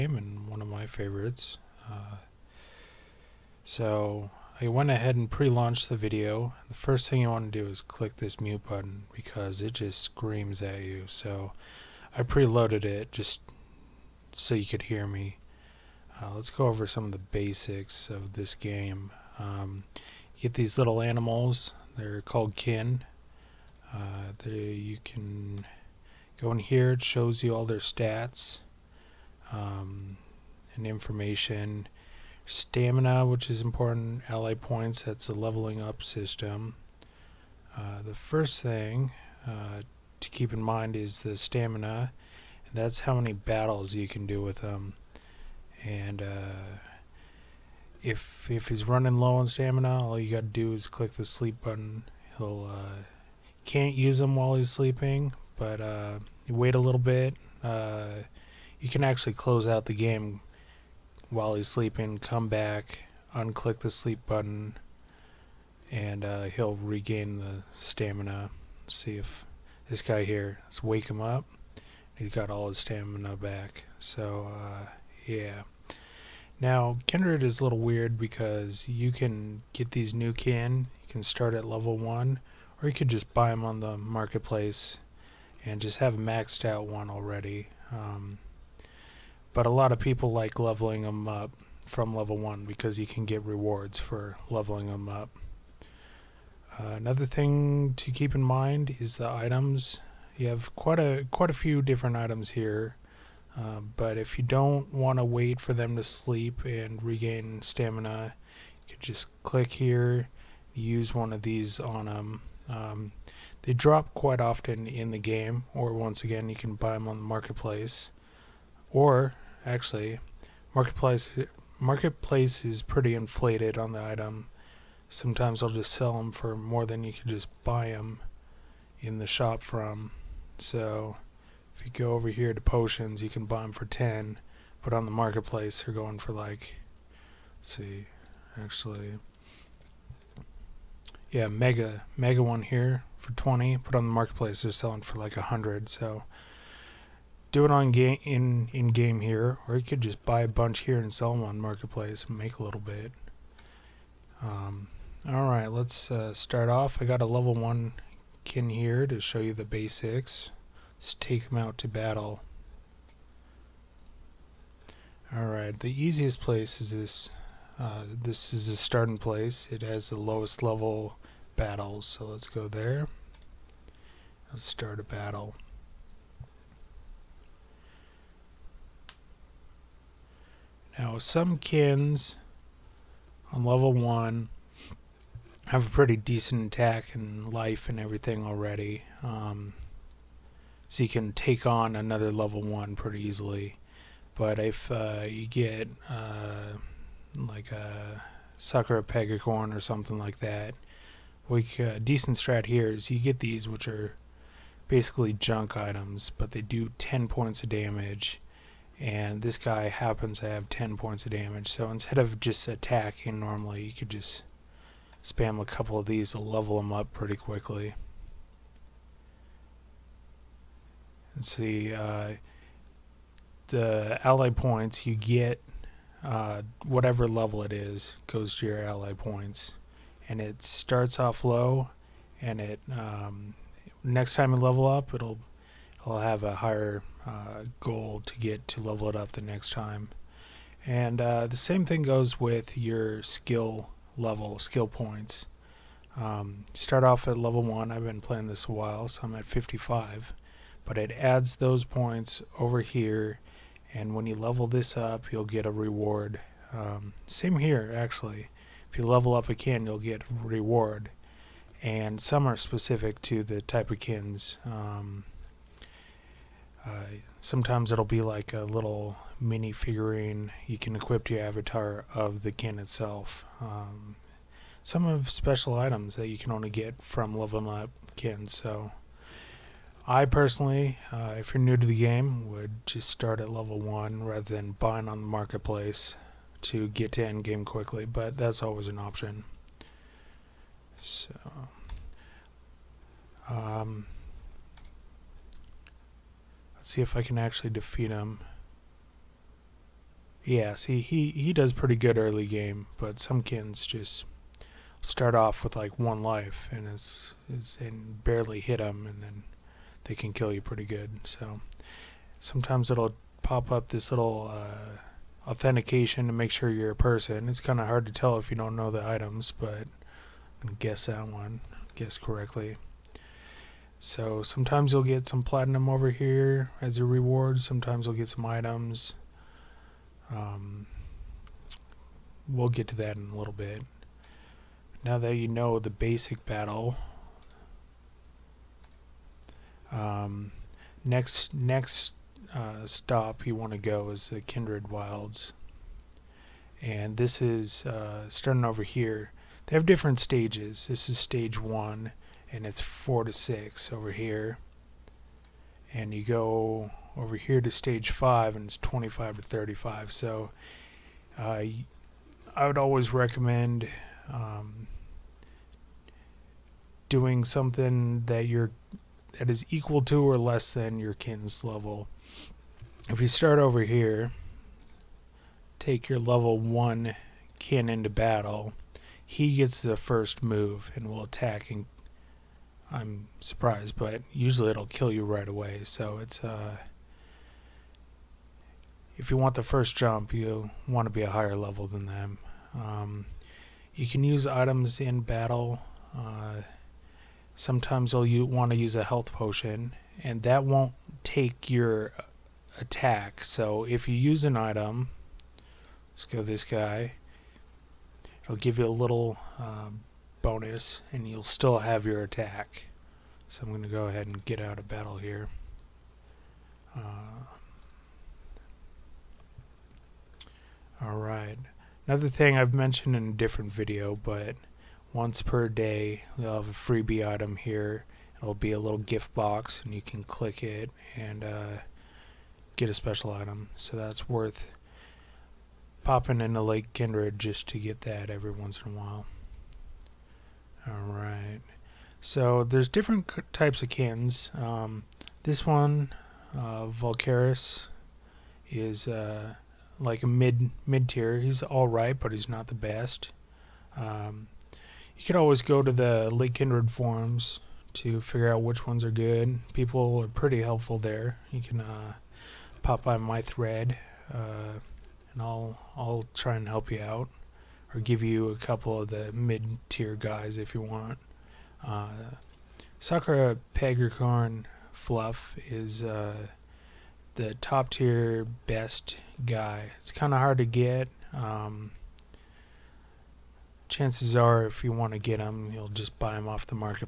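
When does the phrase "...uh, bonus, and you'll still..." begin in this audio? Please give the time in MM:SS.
06:49.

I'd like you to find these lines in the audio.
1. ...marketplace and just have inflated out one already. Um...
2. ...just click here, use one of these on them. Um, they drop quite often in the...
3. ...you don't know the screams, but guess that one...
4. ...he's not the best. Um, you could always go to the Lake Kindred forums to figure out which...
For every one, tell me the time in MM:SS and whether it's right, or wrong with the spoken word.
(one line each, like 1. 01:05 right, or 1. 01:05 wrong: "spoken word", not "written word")
1. 01:23 wrong: "maxed", not "inflated"
2. 01:49 right
3. 05:18 wrong: "items", not "screams"
4. 07:32 right.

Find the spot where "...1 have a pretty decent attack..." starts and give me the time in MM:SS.
03:03.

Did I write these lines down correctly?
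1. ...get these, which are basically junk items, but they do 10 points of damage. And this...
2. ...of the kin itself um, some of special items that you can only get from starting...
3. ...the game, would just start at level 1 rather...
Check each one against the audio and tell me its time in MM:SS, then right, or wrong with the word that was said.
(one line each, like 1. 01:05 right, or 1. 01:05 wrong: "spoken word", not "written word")
1. 03:23 right
2. 04:32 wrong: "leveling", not "starting"
3. 04:41 right.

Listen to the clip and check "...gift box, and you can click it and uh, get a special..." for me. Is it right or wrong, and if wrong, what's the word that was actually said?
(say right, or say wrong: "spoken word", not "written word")
right.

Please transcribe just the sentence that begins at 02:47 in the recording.
Uh, this is the starting place.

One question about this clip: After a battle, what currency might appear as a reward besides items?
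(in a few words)
platinum.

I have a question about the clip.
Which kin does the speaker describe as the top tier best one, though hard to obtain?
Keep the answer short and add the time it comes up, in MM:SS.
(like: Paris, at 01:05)
Sakura Pegacorn Fluff, at 07:52.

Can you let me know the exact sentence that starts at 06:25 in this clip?
So it's uh if you want the first jump, you want to be a higher level than them.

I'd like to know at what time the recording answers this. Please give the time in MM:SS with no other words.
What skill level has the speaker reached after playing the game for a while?
04:09.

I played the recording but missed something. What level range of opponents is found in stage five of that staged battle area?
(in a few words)
25 to 35.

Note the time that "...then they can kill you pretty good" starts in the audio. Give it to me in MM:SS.
05:09.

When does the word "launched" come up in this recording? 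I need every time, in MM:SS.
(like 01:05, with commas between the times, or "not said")
00:05.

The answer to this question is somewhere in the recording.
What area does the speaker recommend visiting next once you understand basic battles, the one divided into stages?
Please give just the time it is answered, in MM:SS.
05:44.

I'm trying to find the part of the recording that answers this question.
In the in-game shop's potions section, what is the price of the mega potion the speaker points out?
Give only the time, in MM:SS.
02:23.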